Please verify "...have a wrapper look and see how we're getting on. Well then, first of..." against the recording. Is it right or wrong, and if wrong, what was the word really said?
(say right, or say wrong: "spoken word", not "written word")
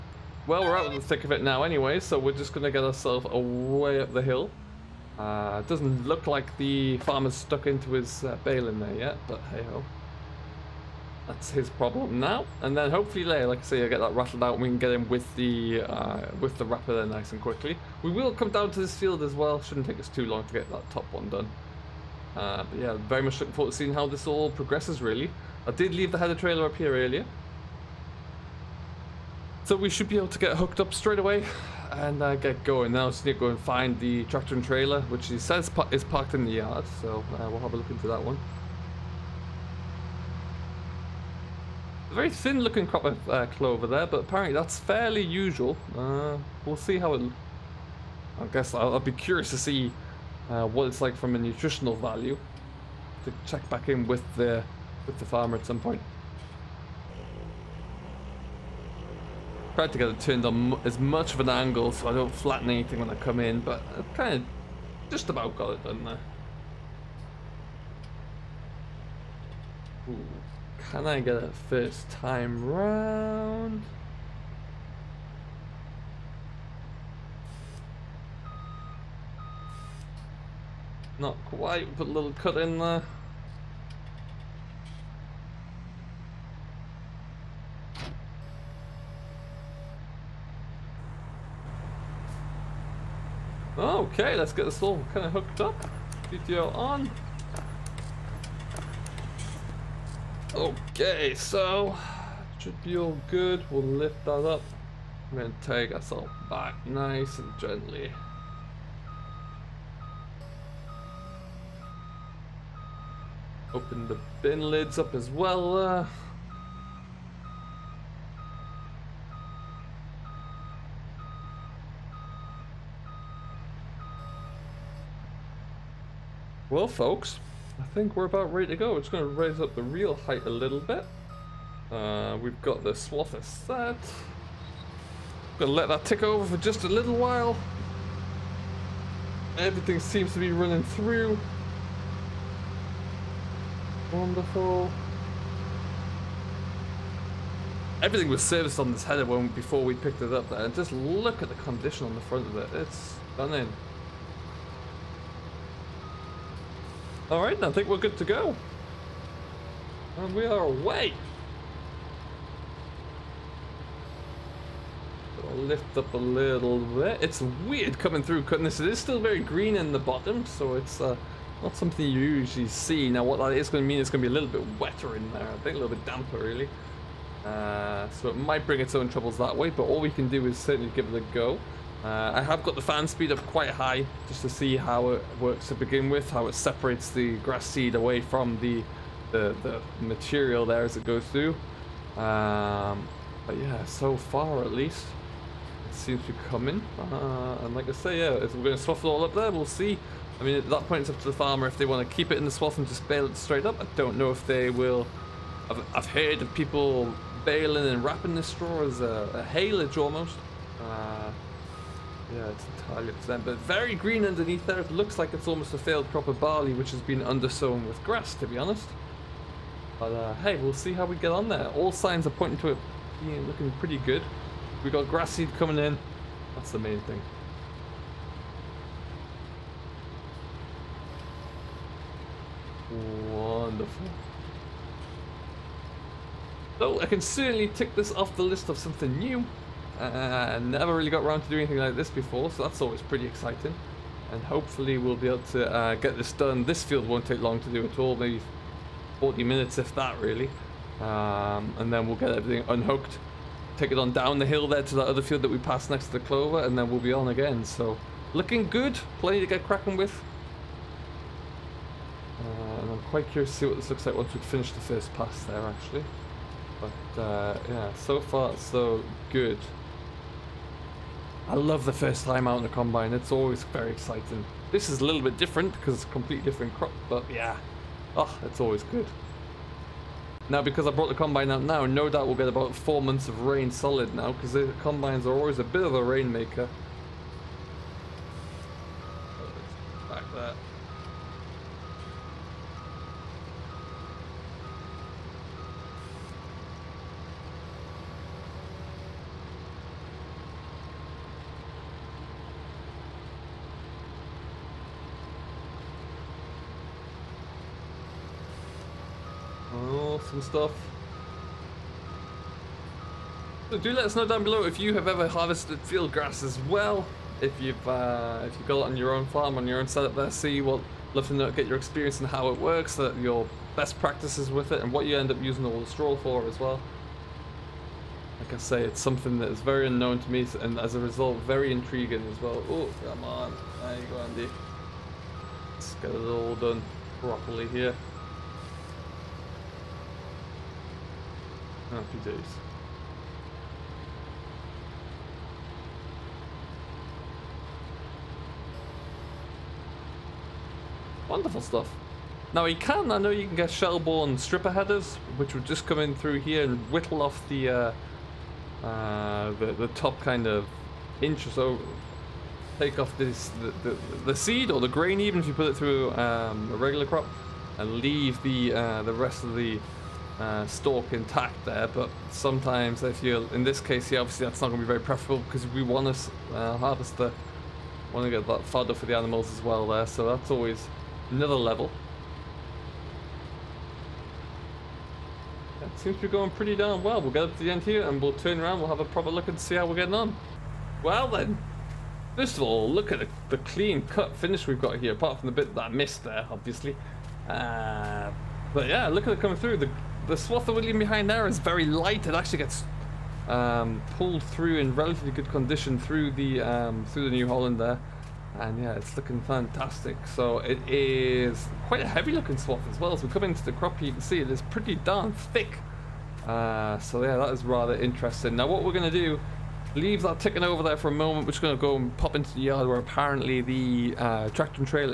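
wrong: "proper", not "wrapper".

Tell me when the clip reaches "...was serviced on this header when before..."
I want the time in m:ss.
2:28.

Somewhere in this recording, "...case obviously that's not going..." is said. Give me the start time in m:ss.
6:13.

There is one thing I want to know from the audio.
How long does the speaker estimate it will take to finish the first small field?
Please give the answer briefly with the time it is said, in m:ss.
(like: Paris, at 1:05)
40 minutes, at 4:09.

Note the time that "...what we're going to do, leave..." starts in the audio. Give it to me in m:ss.
6:58.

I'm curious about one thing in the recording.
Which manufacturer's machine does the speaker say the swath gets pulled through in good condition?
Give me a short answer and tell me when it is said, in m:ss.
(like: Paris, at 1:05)
New Holland, at 6:47.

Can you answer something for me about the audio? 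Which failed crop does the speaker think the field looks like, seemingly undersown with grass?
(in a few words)
barley.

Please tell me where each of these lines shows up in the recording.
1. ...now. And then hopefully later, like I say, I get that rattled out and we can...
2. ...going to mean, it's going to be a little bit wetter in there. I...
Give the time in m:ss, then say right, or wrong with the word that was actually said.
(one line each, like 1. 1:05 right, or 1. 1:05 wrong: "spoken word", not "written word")
1. 0:12 right
2. 2:53 right.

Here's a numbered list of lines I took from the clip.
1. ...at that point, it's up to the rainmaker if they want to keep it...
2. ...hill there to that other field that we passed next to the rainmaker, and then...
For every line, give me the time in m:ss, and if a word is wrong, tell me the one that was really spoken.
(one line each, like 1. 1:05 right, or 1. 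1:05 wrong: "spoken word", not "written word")
1. 3:20 wrong: "farmer", not "rainmaker"
2. 4:14 wrong: "clover", not "rainmaker".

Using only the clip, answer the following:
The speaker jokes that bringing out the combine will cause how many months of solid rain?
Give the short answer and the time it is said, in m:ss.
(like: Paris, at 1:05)
4 months, at 4:42.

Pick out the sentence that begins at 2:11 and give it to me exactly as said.
Uh, we've got the swather set.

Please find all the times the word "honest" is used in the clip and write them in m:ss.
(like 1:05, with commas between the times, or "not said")
3:38.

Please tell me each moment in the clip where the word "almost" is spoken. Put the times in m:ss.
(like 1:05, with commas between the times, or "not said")
3:29, 3:35.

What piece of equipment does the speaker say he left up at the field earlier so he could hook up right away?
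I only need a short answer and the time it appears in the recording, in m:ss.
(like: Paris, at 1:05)
header trailer, at 0:26.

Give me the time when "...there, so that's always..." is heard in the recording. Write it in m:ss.
6:19.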